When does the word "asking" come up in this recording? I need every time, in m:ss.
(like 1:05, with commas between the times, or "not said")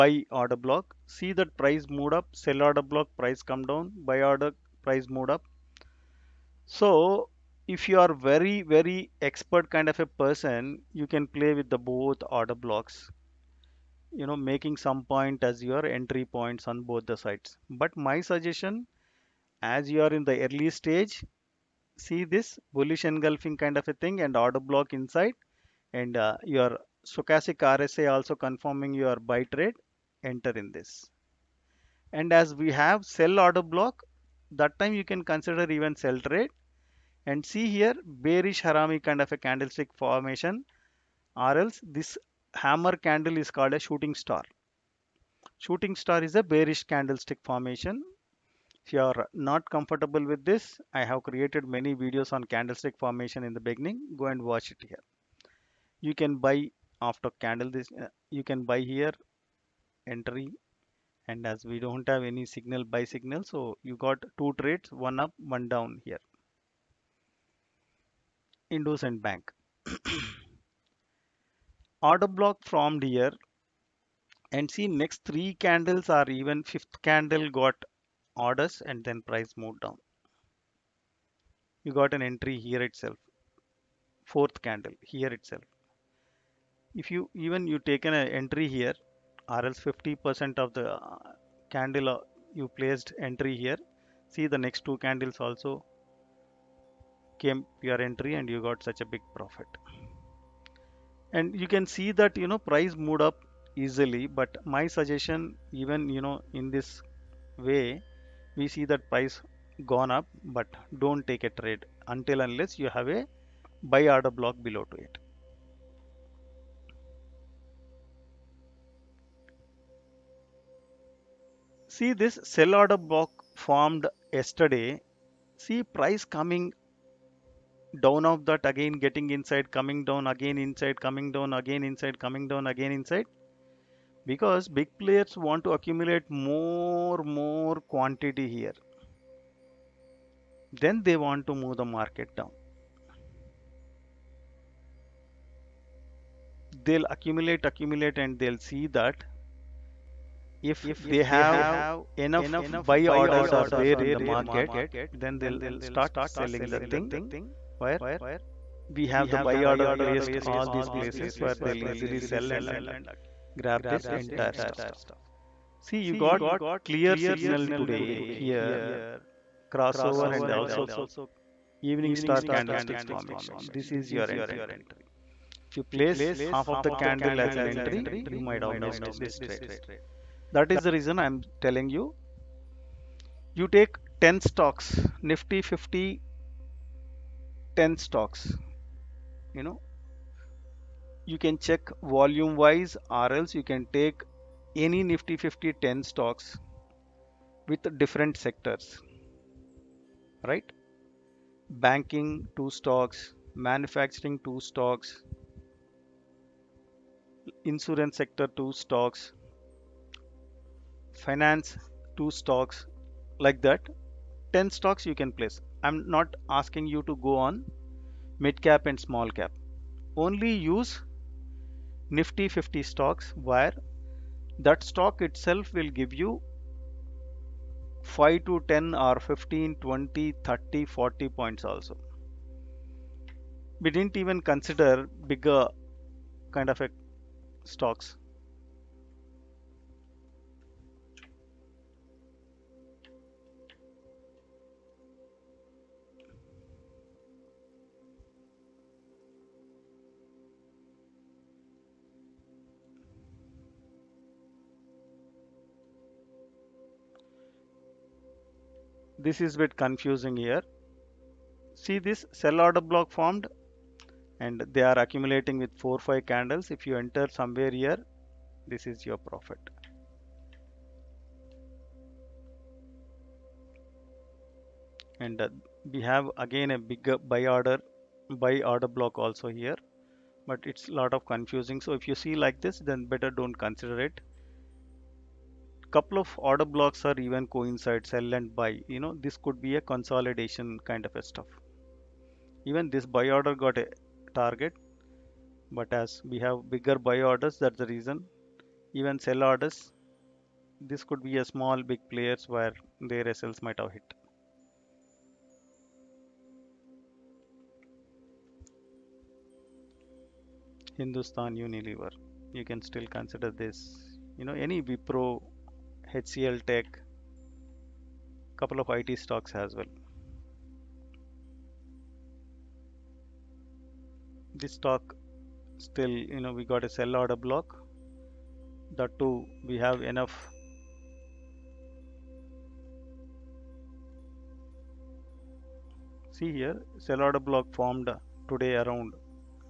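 3:36.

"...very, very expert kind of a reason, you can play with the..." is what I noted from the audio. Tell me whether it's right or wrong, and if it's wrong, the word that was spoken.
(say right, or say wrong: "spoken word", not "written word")
wrong: "person", not "reason".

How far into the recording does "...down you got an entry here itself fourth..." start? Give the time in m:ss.
1:19.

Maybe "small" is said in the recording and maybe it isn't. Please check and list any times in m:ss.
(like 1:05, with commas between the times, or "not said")
3:39, 5:01.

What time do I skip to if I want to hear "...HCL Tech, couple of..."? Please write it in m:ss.
5:16.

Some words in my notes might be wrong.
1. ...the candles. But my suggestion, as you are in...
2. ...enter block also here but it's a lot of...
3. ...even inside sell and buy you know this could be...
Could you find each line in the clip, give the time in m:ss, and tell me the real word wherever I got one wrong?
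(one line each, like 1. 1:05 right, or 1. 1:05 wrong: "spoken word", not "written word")
1. 0:17 wrong: "sides", not "candles"
2. 4:38 wrong: "order", not "enter"
3. 4:47 wrong: "coincide", not "inside".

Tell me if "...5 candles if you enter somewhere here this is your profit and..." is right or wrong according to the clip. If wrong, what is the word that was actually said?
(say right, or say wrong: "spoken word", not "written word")
right.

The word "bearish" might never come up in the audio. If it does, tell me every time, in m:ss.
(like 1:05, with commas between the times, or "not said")
0:38, 0:46.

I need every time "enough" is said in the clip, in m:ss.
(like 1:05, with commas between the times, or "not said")
2:32, 5:30.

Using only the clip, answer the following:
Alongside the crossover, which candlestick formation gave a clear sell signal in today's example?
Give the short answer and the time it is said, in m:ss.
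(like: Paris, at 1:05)
Evening star, at 2:51.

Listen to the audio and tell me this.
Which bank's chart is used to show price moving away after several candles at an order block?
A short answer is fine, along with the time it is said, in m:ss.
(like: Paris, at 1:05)
IndusInd Bank, at 1:08.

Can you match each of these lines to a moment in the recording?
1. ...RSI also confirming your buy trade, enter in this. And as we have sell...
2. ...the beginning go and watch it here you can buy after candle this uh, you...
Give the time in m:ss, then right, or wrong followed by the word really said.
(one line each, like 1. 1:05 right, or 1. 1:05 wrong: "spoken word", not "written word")
1. 0:27 right
2. 0:53 right.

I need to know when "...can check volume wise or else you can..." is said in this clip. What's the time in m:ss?
3:11.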